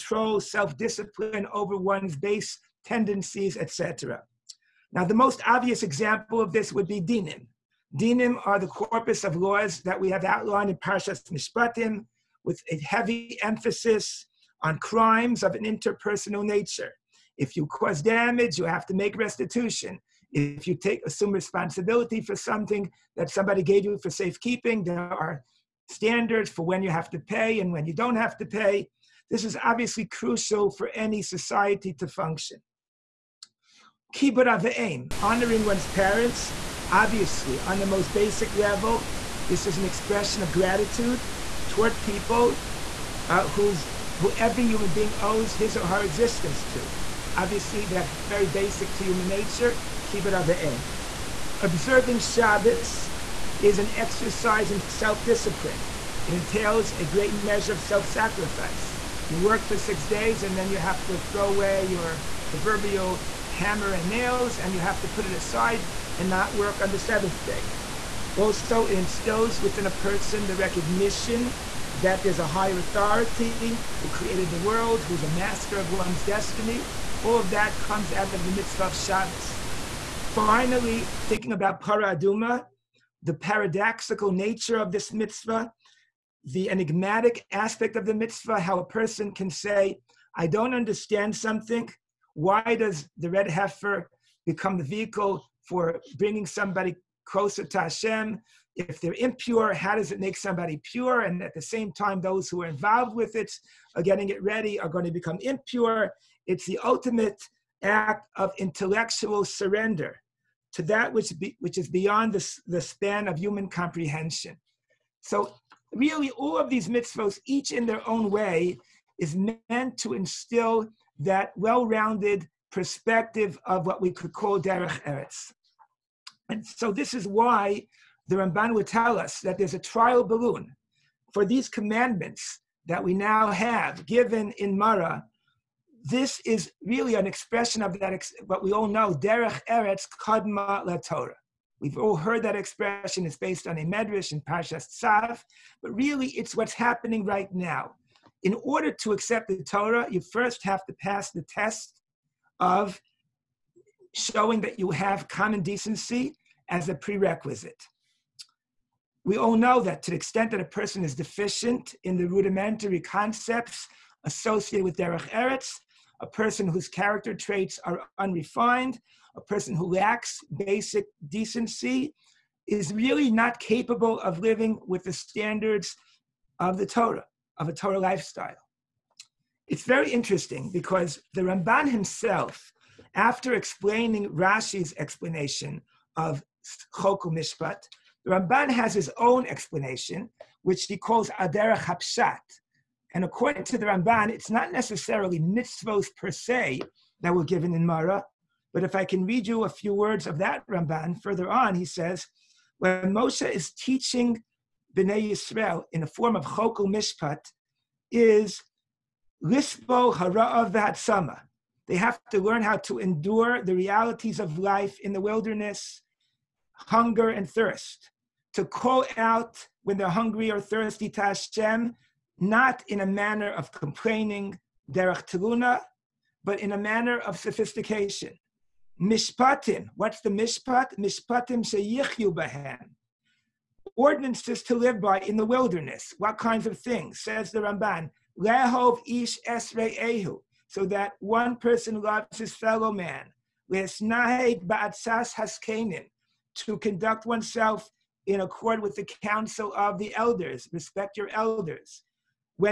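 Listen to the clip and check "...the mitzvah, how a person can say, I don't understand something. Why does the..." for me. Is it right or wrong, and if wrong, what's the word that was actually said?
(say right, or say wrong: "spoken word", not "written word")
right.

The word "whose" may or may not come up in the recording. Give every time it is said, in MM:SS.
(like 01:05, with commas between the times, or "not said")
00:43, 02:46.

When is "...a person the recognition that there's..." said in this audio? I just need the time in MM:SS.
01:09.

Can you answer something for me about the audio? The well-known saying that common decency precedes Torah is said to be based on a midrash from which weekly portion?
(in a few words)
Parshas Tzav.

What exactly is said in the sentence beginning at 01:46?
It's the ultimate act of intellectual surrender to that which, be, which is beyond the, the span of human comprehension.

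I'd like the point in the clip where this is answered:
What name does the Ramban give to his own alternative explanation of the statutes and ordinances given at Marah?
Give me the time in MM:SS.
03:11.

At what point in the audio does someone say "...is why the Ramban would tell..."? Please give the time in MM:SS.
02:07.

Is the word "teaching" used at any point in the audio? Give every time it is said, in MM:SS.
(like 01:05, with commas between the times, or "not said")
03:23.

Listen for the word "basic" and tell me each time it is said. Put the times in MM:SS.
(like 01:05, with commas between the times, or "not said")
00:38, 00:48, 02:50.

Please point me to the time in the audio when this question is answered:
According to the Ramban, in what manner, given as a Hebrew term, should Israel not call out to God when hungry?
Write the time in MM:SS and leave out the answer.
03:44.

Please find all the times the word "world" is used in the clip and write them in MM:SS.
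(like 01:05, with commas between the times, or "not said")
01:14.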